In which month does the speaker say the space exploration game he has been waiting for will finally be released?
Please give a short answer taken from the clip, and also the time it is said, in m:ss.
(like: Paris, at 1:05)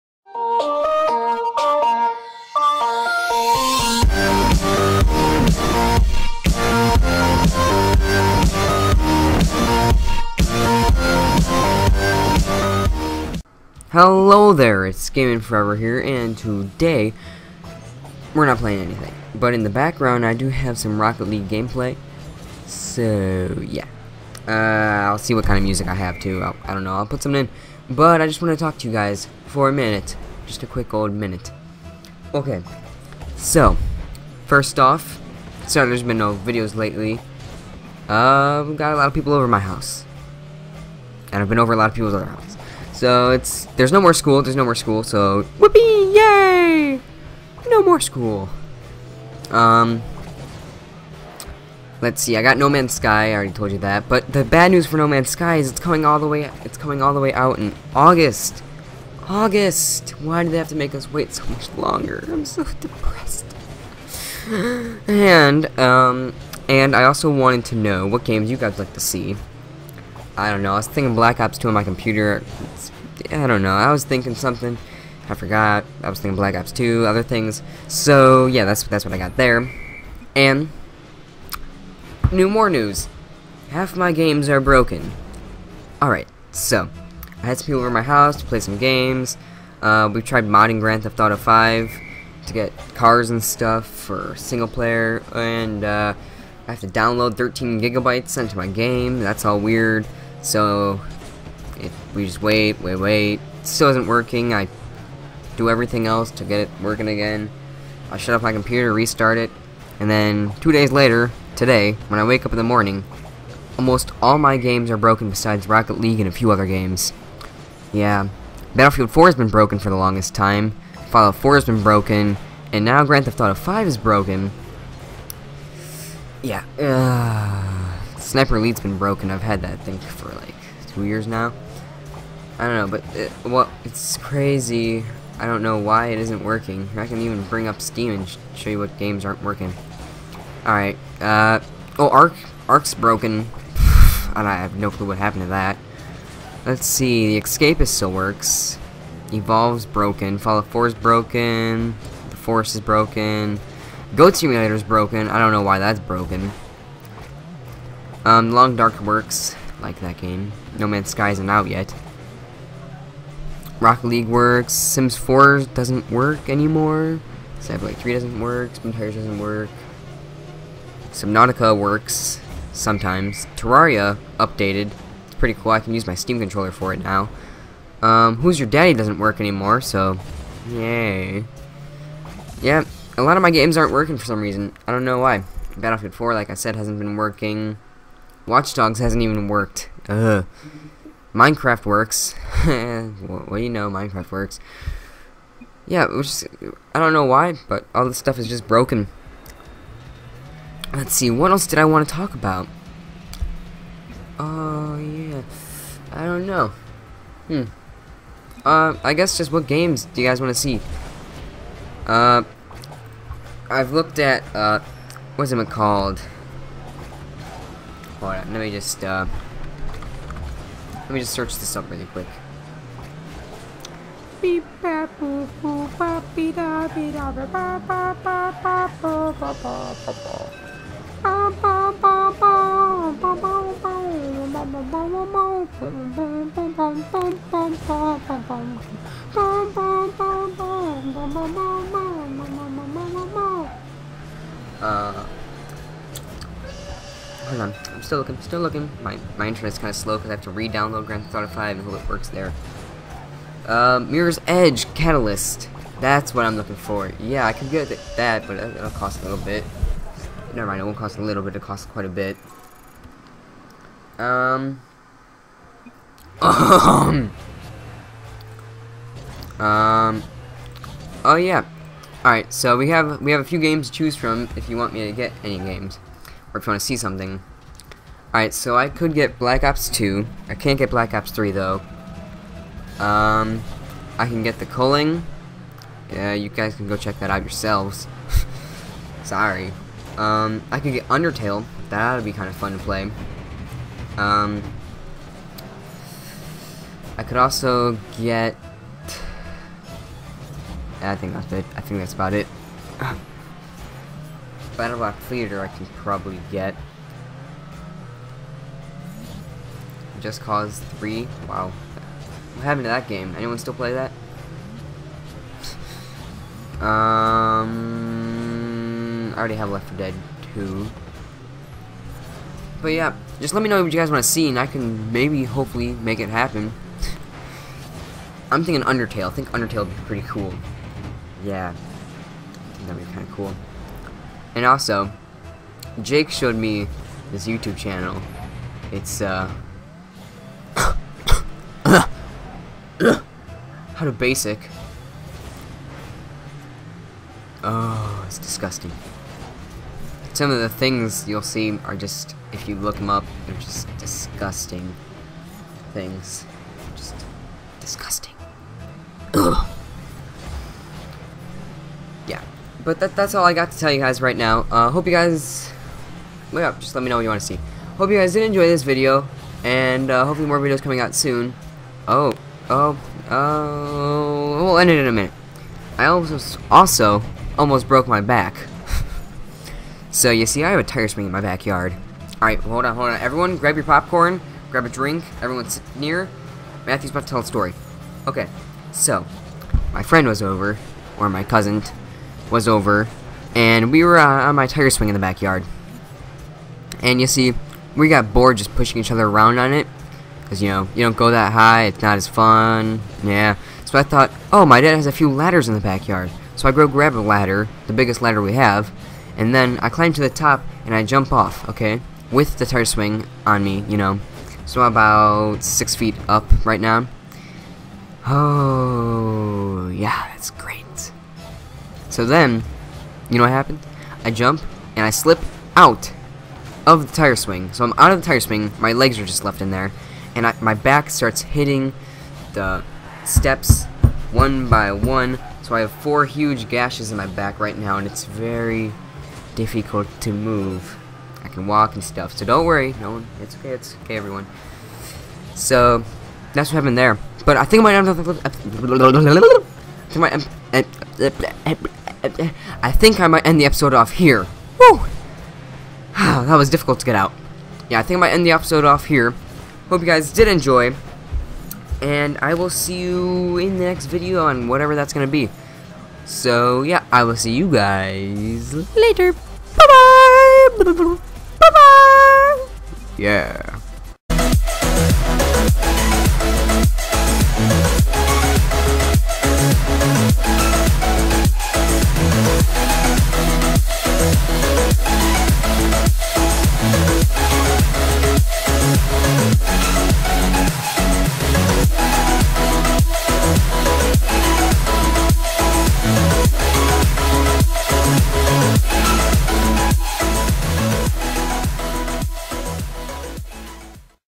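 August, at 0:56.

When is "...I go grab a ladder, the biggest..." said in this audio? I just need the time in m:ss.
6:46.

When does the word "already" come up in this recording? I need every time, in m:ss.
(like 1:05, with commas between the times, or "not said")
0:53, 5:19.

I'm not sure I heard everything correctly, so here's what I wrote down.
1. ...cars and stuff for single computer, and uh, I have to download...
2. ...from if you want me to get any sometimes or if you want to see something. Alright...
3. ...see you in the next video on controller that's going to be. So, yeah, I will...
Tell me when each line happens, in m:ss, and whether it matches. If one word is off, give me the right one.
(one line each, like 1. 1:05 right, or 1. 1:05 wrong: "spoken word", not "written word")
1. 1:32 wrong: "player", not "computer"
2. 4:34 wrong: "games", not "sometimes"
3. 7:42 wrong: "whatever", not "controller".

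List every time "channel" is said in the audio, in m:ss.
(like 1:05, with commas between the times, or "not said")
5:37.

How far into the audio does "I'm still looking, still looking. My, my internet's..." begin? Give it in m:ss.
4:07.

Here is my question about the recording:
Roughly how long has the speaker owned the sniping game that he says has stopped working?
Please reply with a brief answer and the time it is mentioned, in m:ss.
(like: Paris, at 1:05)
two years, at 2:10.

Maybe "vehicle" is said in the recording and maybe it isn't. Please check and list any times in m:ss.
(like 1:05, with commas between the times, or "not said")
not said.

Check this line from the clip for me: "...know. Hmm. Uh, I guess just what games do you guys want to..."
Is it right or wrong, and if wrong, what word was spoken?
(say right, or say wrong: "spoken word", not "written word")
right.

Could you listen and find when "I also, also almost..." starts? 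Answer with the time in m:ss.
6:15.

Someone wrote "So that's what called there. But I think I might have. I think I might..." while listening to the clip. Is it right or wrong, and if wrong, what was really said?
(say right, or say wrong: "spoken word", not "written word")
wrong: "happened", not "called".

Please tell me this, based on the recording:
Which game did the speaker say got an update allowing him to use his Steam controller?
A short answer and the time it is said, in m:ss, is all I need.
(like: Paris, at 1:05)
Terraria, at 2:53.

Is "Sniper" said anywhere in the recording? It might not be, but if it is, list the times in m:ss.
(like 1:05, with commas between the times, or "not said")
2:08, 2:47.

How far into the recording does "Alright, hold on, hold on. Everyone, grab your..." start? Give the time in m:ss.
6:22.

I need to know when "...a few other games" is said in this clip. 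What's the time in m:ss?
1:56.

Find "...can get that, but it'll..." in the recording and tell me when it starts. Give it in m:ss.
4:17.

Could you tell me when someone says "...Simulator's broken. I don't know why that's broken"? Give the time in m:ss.
2:34.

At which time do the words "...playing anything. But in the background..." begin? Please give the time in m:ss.
0:18.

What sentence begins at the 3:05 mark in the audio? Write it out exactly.
Battlefield 4, like I said, hasn't been working.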